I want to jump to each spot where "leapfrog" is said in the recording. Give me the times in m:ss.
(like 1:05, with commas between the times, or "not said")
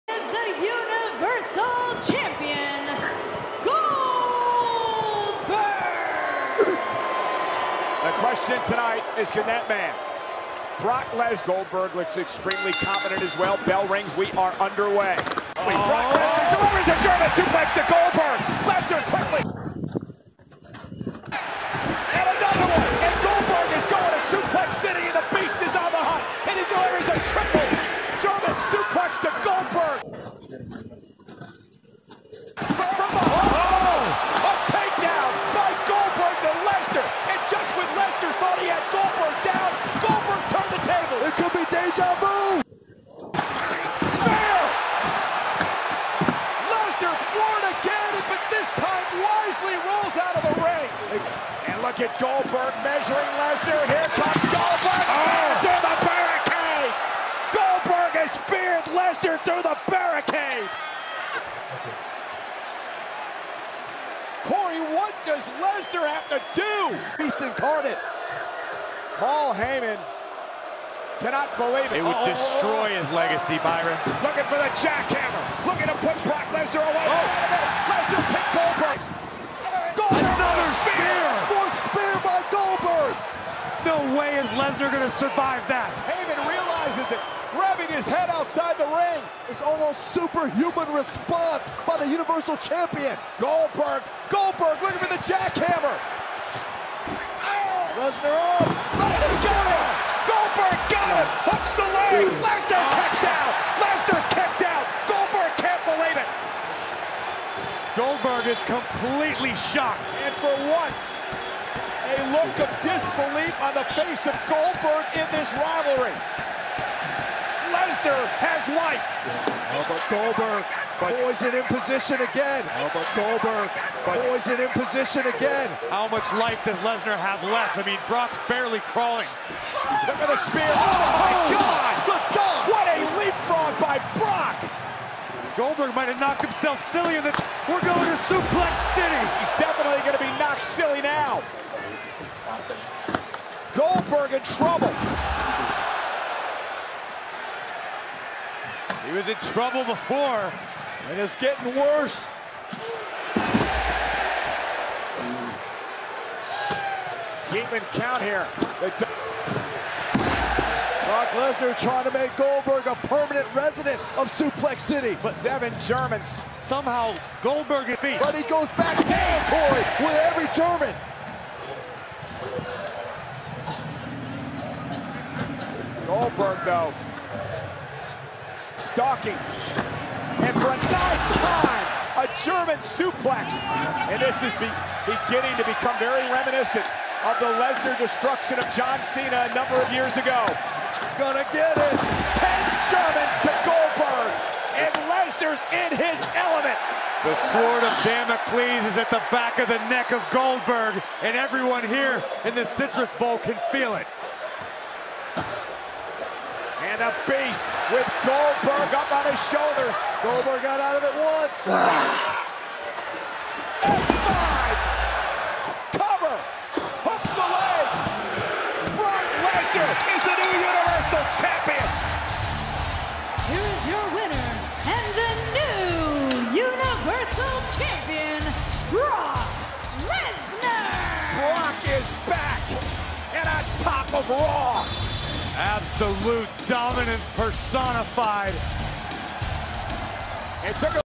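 2:13.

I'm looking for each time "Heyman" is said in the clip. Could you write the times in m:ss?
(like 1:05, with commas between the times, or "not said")
1:09, 1:26.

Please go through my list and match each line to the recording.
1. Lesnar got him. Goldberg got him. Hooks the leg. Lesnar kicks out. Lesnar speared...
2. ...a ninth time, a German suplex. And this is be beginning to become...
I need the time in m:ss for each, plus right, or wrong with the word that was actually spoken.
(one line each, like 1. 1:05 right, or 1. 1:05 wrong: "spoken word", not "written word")
1. 1:38 wrong: "kicked", not "speared"
2. 3:00 right.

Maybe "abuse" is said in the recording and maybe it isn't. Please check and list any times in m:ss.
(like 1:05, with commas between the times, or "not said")
not said.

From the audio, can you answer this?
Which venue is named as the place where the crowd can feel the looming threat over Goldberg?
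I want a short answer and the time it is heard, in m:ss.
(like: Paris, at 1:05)
Citrus Bowl, at 3:22.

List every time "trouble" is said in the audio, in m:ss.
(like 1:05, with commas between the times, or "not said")
2:24, 2:29.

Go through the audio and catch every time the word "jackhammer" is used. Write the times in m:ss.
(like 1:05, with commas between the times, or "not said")
1:14, 1:35.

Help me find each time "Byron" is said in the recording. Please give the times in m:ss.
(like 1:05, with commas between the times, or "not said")
1:13.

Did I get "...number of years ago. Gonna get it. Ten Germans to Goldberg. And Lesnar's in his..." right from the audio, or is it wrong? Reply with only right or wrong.
right.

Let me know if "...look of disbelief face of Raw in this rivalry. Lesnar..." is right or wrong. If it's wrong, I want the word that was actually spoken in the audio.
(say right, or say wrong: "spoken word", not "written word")
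wrong: "Goldberg", not "Raw".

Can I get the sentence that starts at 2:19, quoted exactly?
He's definitely going to be knocked silly now.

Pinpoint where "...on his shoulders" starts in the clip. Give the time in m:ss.
3:29.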